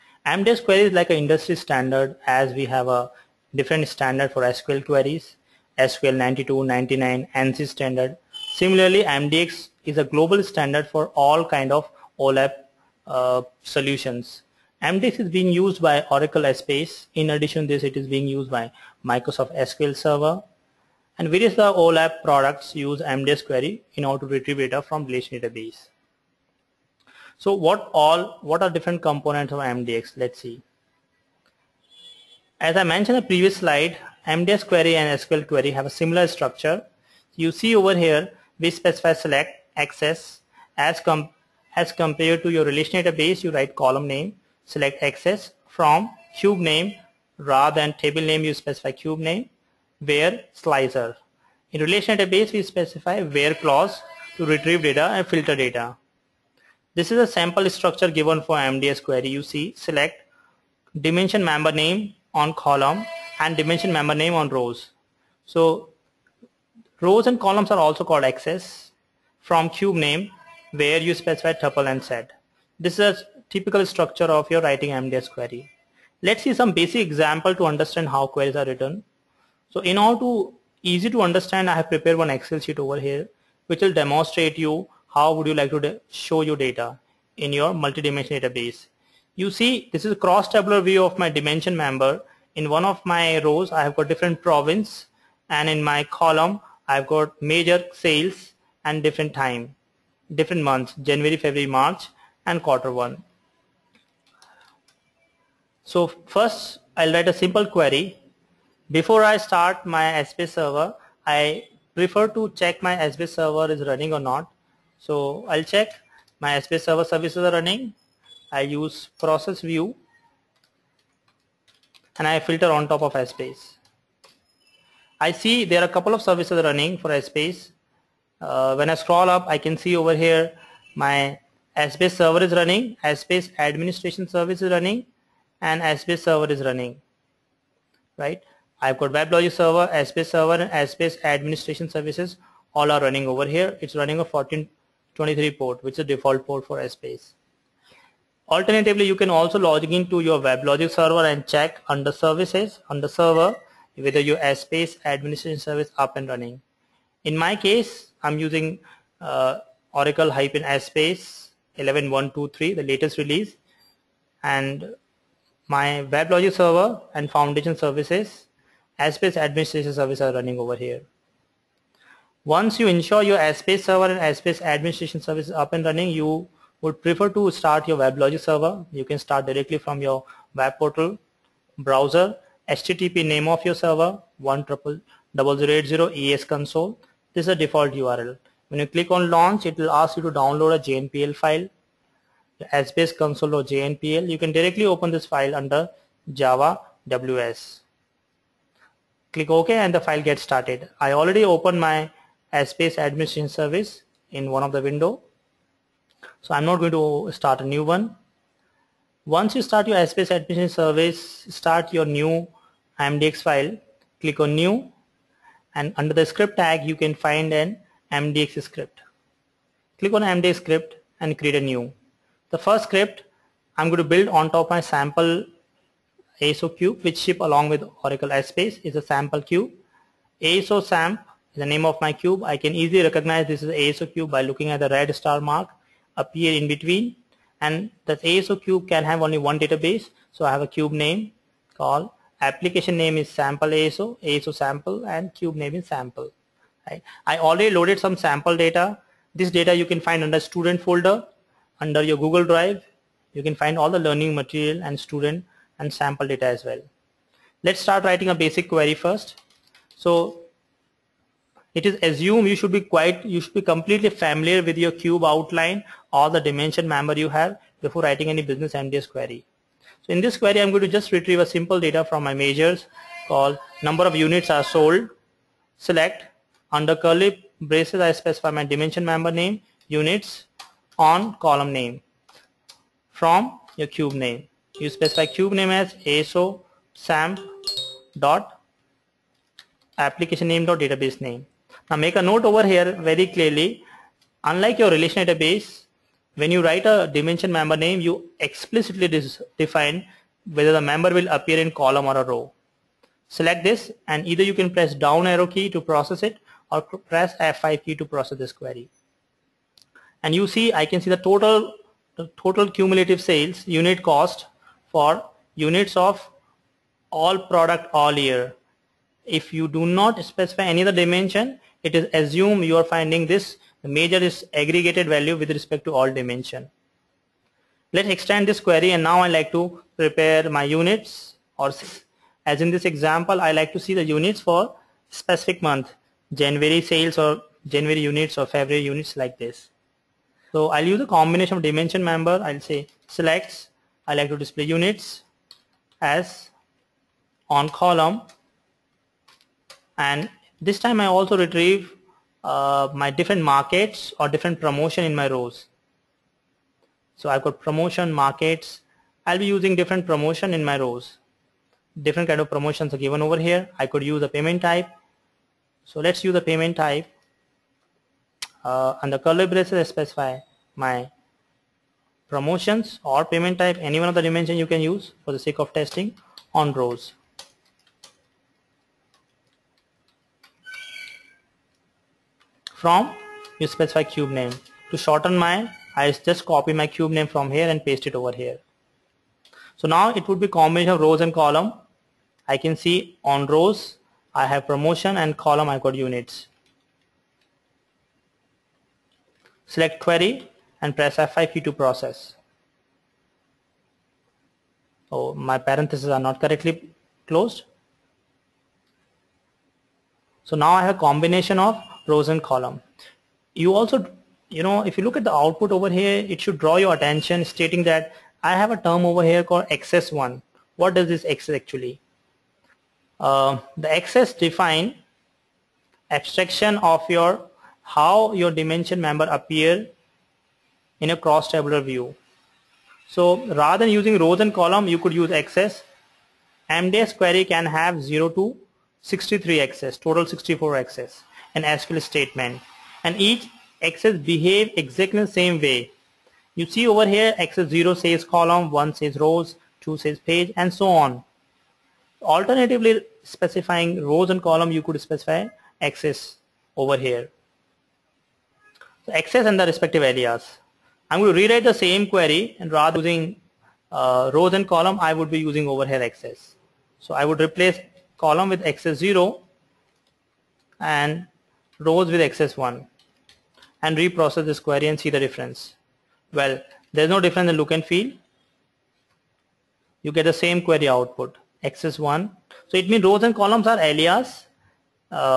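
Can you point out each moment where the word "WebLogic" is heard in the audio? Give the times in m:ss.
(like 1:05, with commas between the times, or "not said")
2:19, 2:30, 2:46, 2:57.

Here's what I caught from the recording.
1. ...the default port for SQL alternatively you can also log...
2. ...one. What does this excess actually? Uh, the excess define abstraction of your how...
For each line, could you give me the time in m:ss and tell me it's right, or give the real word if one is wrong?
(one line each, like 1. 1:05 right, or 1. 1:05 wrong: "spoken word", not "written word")
1. 2:25 wrong: "Essbase", not "SQL"
2. 7:00 right.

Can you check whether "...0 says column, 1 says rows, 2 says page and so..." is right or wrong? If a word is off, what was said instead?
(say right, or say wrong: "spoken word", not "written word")
right.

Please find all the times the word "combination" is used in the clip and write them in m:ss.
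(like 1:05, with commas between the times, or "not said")
5:41, 6:30, 6:50.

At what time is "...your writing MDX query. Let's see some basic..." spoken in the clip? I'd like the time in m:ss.
1:14.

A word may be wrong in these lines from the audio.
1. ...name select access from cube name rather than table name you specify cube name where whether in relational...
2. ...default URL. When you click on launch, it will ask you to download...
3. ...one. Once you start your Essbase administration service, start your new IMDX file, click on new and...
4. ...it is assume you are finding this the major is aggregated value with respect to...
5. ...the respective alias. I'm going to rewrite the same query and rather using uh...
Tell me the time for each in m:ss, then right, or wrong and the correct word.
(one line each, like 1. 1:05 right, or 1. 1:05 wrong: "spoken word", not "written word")
1. 0:44 wrong: "slicer", not "whether"
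2. 3:07 right
3. 3:27 right
4. 5:21 right
5. 7:39 right.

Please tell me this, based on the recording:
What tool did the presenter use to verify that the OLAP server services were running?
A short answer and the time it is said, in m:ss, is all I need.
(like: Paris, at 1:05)
process view, at 1:59.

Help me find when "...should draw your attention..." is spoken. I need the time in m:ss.
6:56.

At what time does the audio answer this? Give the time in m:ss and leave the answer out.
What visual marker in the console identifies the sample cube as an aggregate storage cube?
3:54.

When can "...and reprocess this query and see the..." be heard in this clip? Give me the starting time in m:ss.
7:53.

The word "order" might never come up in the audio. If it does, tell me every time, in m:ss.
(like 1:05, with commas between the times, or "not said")
0:24, 1:19.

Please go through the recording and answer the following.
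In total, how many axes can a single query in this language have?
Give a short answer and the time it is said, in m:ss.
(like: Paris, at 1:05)
64, at 7:20.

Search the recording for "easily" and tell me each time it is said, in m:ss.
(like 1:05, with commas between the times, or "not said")
3:52.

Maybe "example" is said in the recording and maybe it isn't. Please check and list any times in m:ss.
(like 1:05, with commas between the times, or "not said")
1:16, 5:32.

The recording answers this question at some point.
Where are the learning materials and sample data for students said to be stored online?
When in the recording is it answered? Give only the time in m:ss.
4:12.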